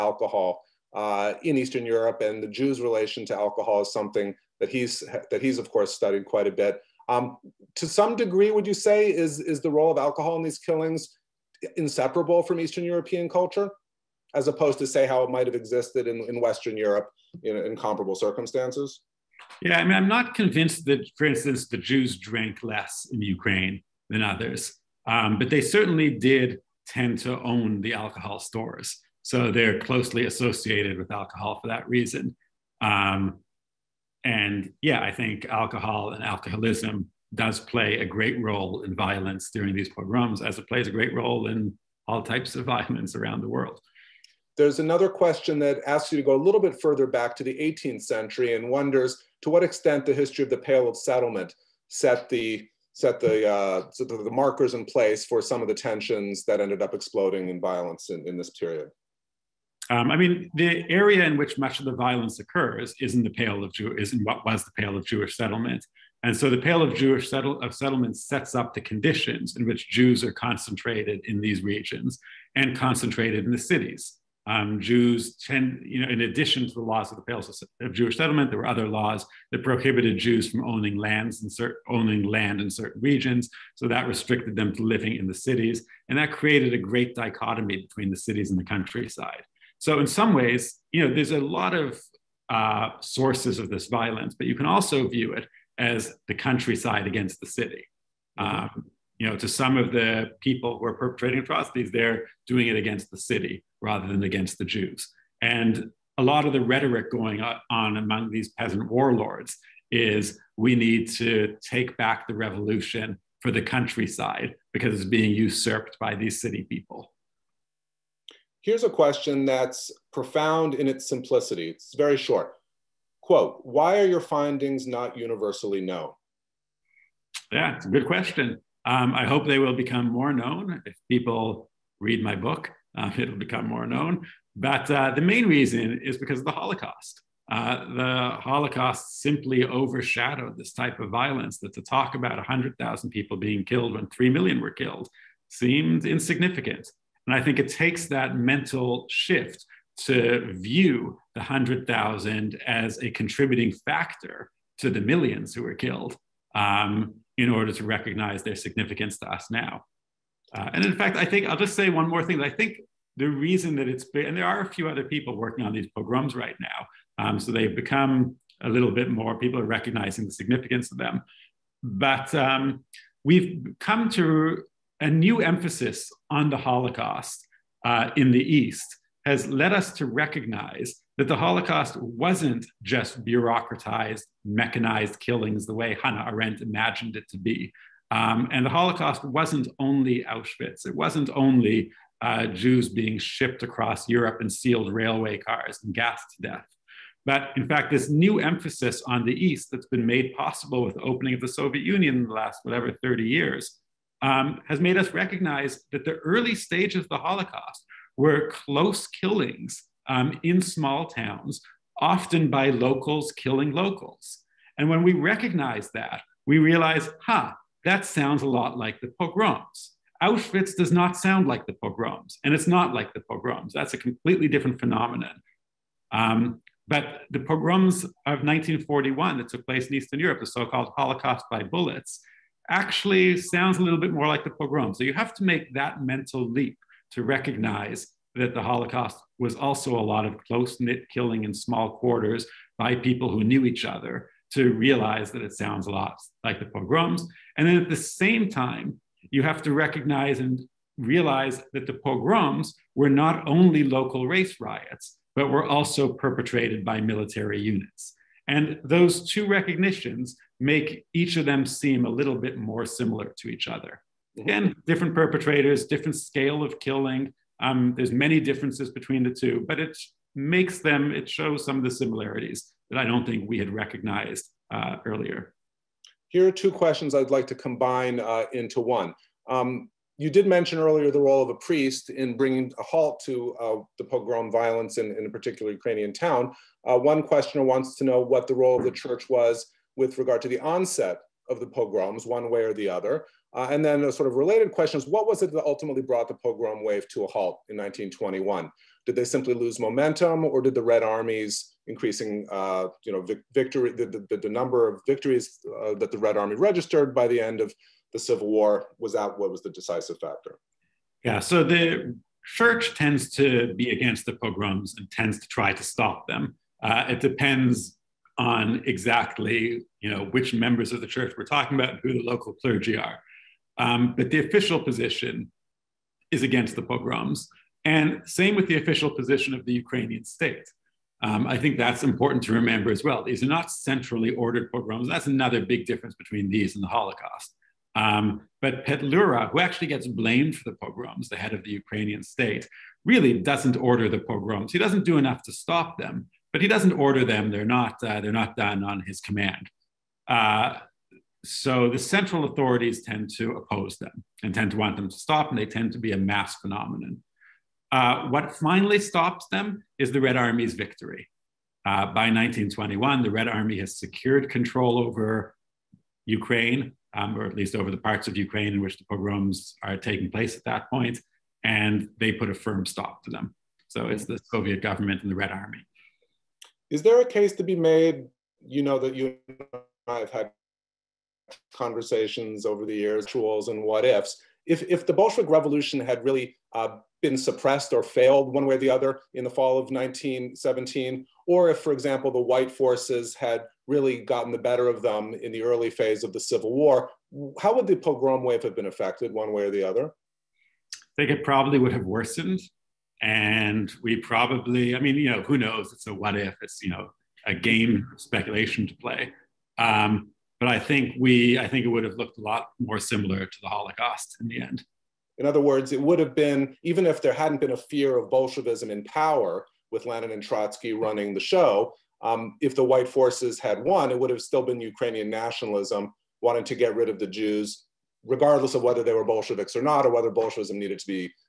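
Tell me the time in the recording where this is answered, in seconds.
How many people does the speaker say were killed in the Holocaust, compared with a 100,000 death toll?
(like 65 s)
144 s.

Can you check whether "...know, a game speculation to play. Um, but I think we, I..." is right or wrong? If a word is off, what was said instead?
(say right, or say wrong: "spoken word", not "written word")
right.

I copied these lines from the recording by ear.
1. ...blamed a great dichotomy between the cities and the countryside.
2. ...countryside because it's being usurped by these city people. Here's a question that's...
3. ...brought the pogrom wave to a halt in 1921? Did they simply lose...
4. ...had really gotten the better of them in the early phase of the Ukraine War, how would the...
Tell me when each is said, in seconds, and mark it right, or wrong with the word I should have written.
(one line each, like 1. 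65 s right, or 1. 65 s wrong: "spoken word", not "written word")
1. 86 s wrong: "created", not "blamed"
2. 113 s right
3. 296 s right
4. 393 s wrong: "Civil", not "Ukraine".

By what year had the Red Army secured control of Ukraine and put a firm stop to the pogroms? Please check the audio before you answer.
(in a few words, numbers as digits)
1921.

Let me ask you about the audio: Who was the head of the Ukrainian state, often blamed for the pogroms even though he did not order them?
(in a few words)
Petlura.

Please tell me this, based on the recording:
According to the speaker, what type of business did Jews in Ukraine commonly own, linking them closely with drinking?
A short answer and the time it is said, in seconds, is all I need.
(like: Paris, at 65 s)
alcohol stores, at 27 s.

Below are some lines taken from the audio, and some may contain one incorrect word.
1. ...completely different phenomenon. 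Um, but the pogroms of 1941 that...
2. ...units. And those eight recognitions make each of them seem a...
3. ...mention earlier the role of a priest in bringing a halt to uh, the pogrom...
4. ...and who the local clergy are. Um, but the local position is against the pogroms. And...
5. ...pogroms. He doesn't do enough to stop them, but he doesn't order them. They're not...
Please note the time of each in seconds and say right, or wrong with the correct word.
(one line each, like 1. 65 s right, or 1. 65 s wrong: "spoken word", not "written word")
1. 223 s right
2. 257 s wrong: "two", not "eight"
3. 280 s right
4. 321 s wrong: "official", not "local"
5. 344 s right.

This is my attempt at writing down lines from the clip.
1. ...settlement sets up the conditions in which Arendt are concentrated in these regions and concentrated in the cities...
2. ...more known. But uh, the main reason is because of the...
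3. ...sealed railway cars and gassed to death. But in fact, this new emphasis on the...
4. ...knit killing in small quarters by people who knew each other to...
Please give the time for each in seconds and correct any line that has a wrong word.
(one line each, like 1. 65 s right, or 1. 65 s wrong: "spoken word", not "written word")
1. 67 s wrong: "Jews", not "Arendt"
2. 133 s right
3. 194 s right
4. 240 s right.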